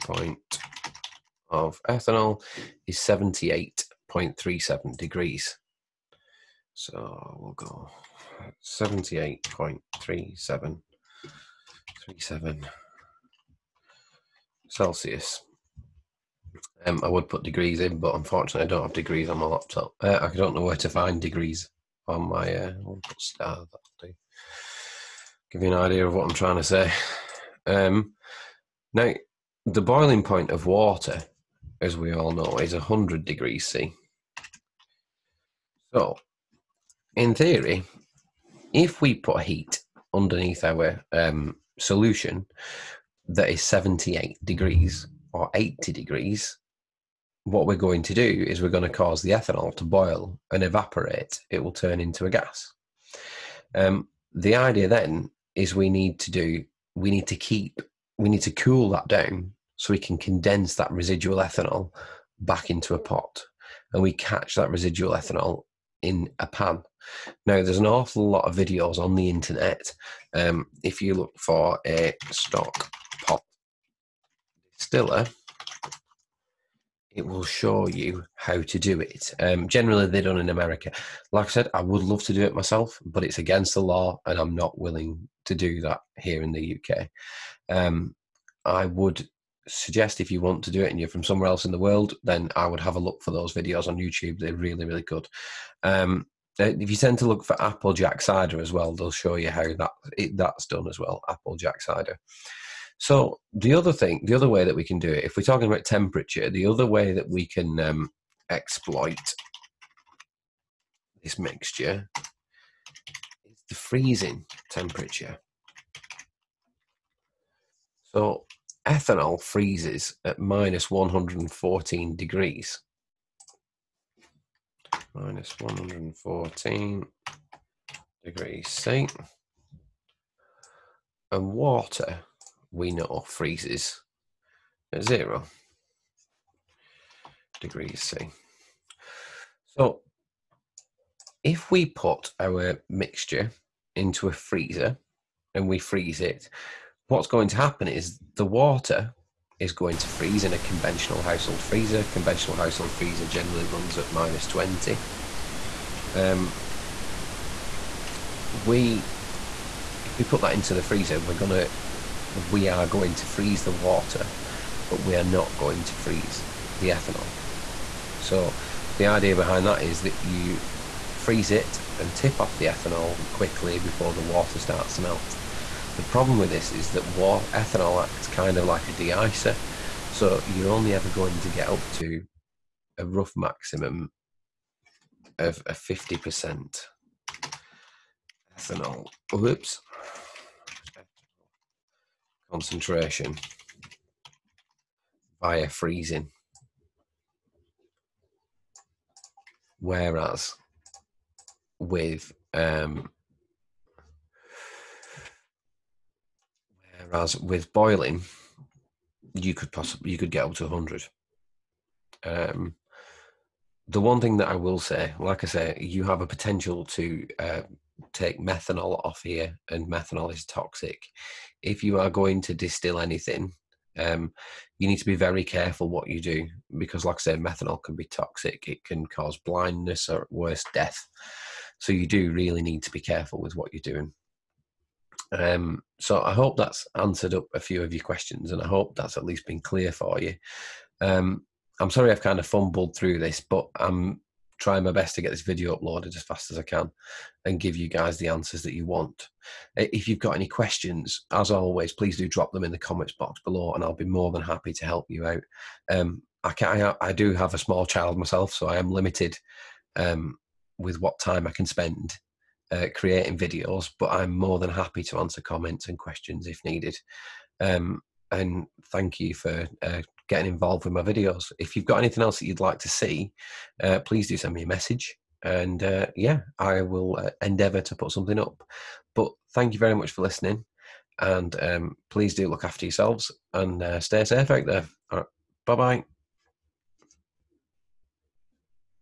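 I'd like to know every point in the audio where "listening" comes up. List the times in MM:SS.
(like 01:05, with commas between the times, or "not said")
04:40.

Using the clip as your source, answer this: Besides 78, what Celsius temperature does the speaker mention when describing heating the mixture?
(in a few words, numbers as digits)
80.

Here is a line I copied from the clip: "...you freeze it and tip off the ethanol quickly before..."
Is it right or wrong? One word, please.
right.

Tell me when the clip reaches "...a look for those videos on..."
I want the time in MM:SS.
01:32.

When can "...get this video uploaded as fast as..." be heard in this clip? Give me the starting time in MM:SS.
04:05.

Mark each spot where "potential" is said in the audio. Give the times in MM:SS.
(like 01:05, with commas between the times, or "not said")
03:36.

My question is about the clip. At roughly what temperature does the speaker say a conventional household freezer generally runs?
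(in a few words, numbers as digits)
-20.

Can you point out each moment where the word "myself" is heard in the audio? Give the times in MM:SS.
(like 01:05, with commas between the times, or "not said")
01:22, 04:18.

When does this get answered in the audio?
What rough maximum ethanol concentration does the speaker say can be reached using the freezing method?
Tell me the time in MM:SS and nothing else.
03:05.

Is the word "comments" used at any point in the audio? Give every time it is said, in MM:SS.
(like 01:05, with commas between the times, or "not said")
04:12, 04:25.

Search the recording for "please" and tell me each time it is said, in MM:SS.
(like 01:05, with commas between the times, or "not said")
04:11, 04:33, 04:42.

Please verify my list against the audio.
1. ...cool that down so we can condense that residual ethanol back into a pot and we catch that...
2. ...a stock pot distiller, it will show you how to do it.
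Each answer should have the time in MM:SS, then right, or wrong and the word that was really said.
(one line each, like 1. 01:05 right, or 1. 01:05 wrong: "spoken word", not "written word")
1. 00:58 right
2. 01:11 right.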